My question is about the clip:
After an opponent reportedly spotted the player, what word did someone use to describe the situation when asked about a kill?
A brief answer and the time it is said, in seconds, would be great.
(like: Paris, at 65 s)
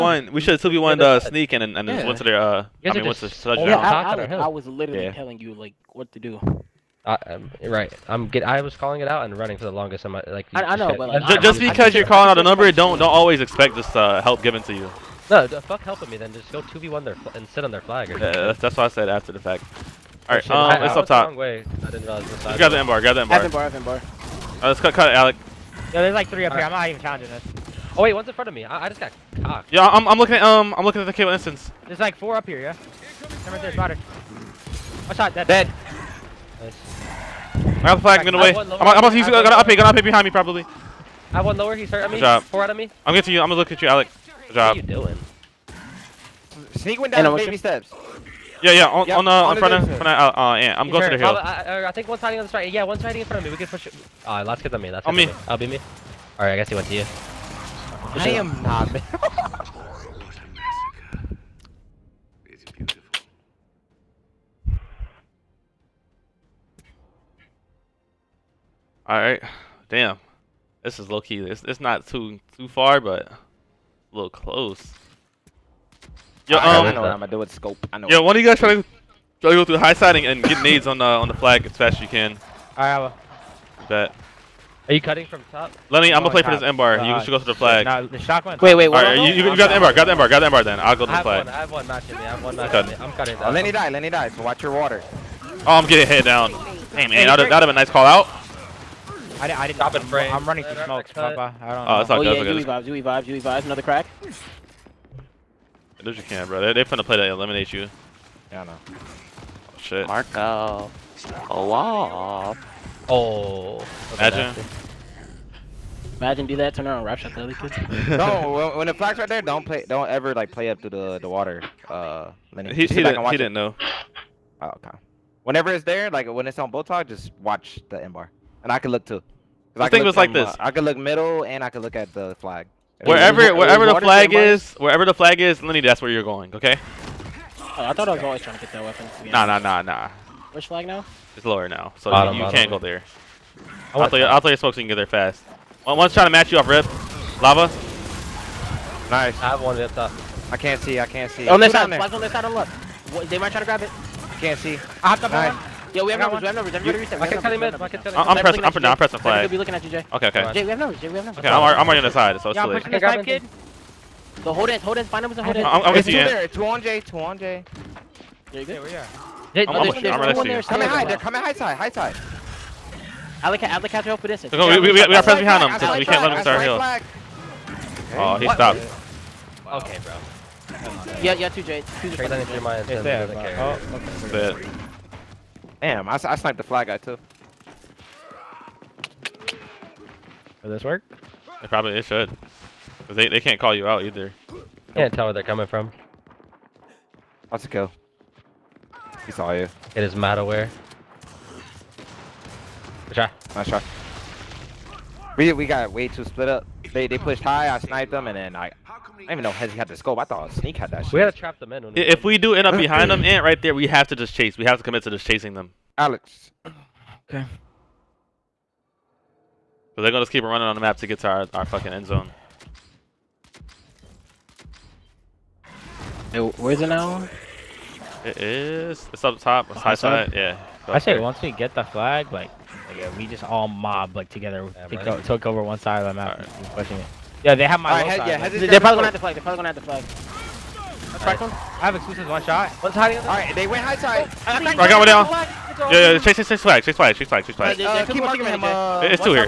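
Malware, at 200 s.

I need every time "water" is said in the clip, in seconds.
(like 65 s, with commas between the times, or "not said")
94 s, 121 s.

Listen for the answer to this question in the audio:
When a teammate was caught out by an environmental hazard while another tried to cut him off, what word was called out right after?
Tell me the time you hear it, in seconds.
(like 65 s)
147 s.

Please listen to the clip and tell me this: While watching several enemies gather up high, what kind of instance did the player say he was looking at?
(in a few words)
Cable instance.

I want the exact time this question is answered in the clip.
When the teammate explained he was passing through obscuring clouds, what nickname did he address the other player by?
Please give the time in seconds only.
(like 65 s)
101 s.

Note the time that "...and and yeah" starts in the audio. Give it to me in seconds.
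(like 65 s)
1 s.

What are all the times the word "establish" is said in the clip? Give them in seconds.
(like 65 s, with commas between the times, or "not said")
not said.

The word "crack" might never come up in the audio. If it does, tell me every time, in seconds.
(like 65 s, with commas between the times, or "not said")
103 s.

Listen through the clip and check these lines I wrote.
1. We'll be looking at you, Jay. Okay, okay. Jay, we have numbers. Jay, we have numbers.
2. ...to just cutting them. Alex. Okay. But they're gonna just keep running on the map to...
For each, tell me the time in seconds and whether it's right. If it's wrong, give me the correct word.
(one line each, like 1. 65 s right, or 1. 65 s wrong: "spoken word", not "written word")
1. 159 s right
2. 215 s wrong: "chasing", not "cutting".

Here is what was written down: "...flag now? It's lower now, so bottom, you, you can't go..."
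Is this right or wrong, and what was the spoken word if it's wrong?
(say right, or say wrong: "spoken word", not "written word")
right.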